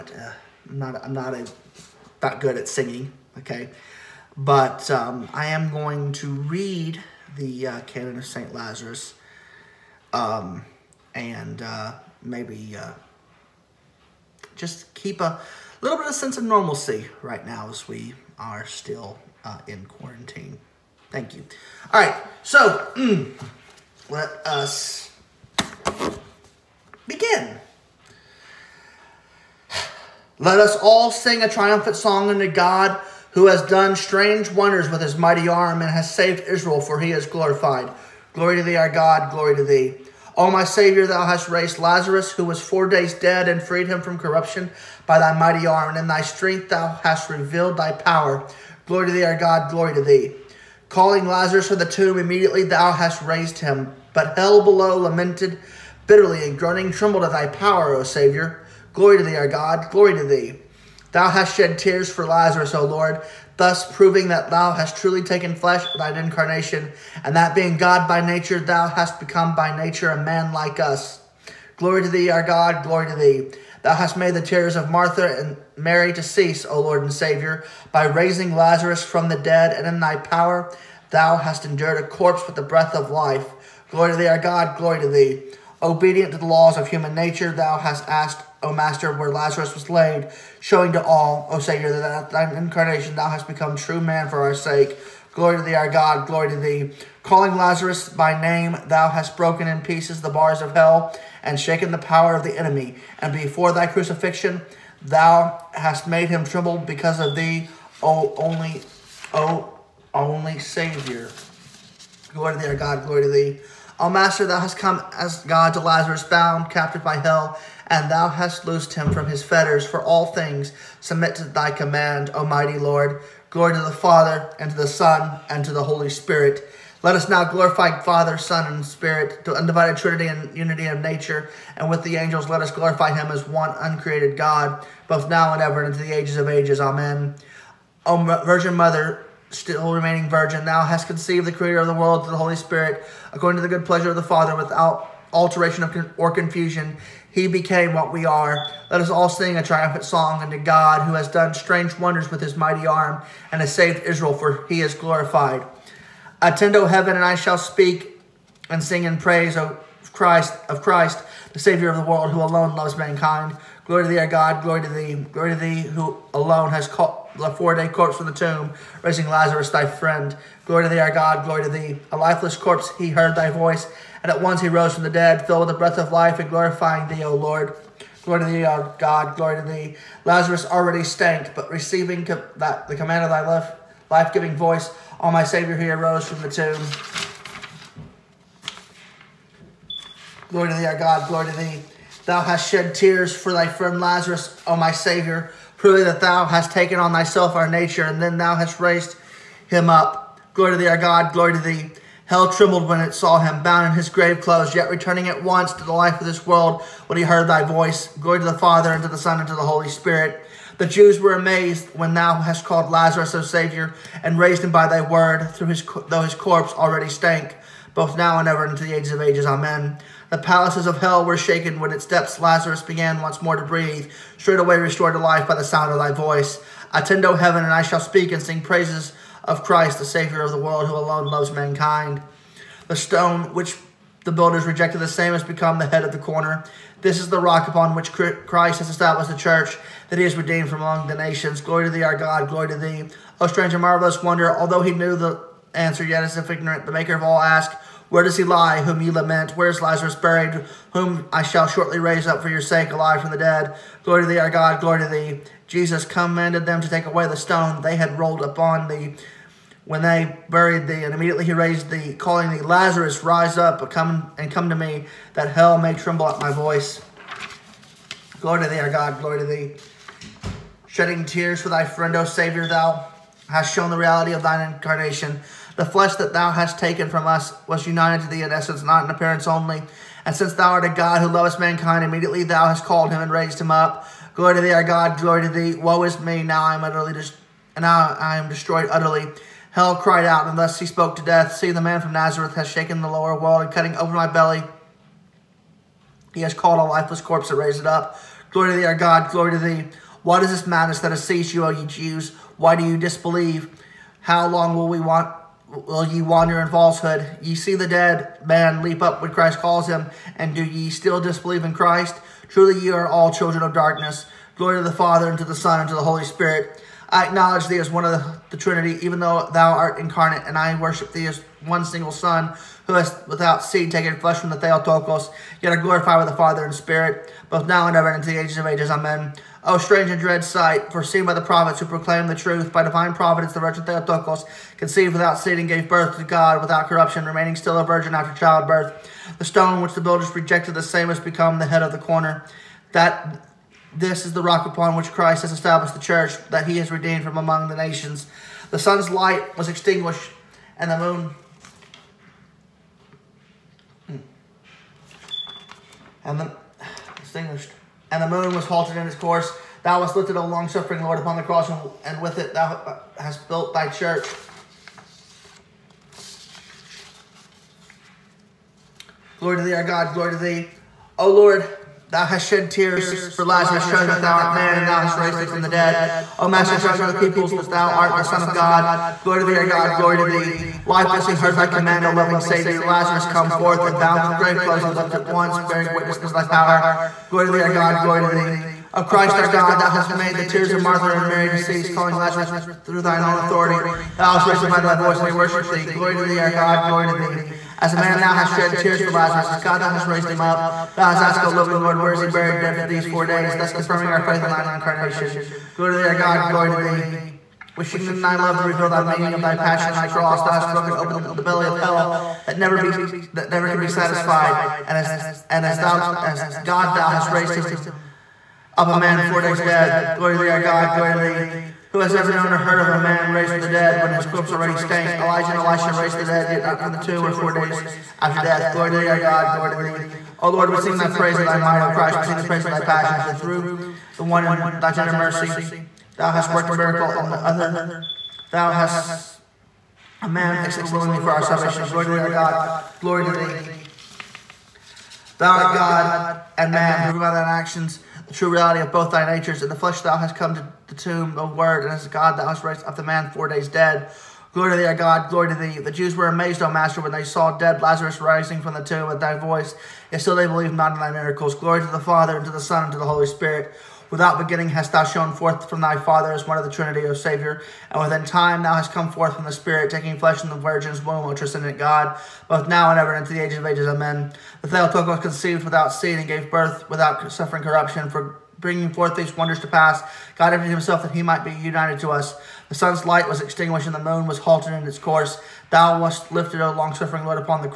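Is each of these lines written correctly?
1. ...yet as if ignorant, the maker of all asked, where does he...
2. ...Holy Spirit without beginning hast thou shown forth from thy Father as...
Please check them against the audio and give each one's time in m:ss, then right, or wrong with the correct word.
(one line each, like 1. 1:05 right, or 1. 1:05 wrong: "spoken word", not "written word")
1. 4:06 right
2. 7:43 right.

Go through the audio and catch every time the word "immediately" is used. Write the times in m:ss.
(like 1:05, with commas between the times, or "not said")
0:52, 4:21, 4:42.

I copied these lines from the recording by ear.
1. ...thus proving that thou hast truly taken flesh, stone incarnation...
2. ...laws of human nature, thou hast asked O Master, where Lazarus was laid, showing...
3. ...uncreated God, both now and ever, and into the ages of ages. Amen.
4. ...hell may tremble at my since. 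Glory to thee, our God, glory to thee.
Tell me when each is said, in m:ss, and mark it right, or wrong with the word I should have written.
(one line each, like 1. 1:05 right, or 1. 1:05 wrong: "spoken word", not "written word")
1. 1:03 wrong: "thine", not "stone"
2. 1:26 right
3. 2:13 right
4. 4:25 wrong: "voice", not "since".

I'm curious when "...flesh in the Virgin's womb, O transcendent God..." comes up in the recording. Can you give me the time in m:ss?
7:50.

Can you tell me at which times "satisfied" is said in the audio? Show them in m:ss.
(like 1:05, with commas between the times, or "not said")
6:53.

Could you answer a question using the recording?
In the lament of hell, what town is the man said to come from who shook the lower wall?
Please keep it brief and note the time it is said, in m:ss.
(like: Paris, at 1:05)
Nazareth, at 4:52.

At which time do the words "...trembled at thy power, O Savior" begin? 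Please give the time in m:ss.
0:56.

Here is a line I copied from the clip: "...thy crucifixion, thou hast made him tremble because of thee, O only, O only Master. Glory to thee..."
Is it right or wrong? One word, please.
wrong.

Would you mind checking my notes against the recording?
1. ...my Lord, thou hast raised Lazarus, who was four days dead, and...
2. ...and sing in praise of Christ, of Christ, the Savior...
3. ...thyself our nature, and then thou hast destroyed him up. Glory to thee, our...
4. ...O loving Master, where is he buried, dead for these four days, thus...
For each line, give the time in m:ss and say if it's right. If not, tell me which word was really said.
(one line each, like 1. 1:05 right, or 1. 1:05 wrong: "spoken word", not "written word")
1. 0:40 wrong: "Savior", not "Lord"
2. 2:38 right
3. 3:17 wrong: "raised", not "destroyed"
4. 6:41 wrong: "Lord", not "Master".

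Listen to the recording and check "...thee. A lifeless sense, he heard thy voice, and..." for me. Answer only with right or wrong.
wrong.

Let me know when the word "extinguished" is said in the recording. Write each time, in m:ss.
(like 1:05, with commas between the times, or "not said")
5:49, 5:57, 8:03.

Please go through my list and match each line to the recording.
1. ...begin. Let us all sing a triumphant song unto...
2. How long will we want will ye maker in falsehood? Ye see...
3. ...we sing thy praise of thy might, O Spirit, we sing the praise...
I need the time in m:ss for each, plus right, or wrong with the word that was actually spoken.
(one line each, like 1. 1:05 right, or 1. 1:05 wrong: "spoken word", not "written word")
1. 0:27 right
2. 5:04 wrong: "wander", not "maker"
3. 7:10 wrong: "Christ", not "Spirit".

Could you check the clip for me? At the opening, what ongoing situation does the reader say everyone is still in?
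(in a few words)
quarantine.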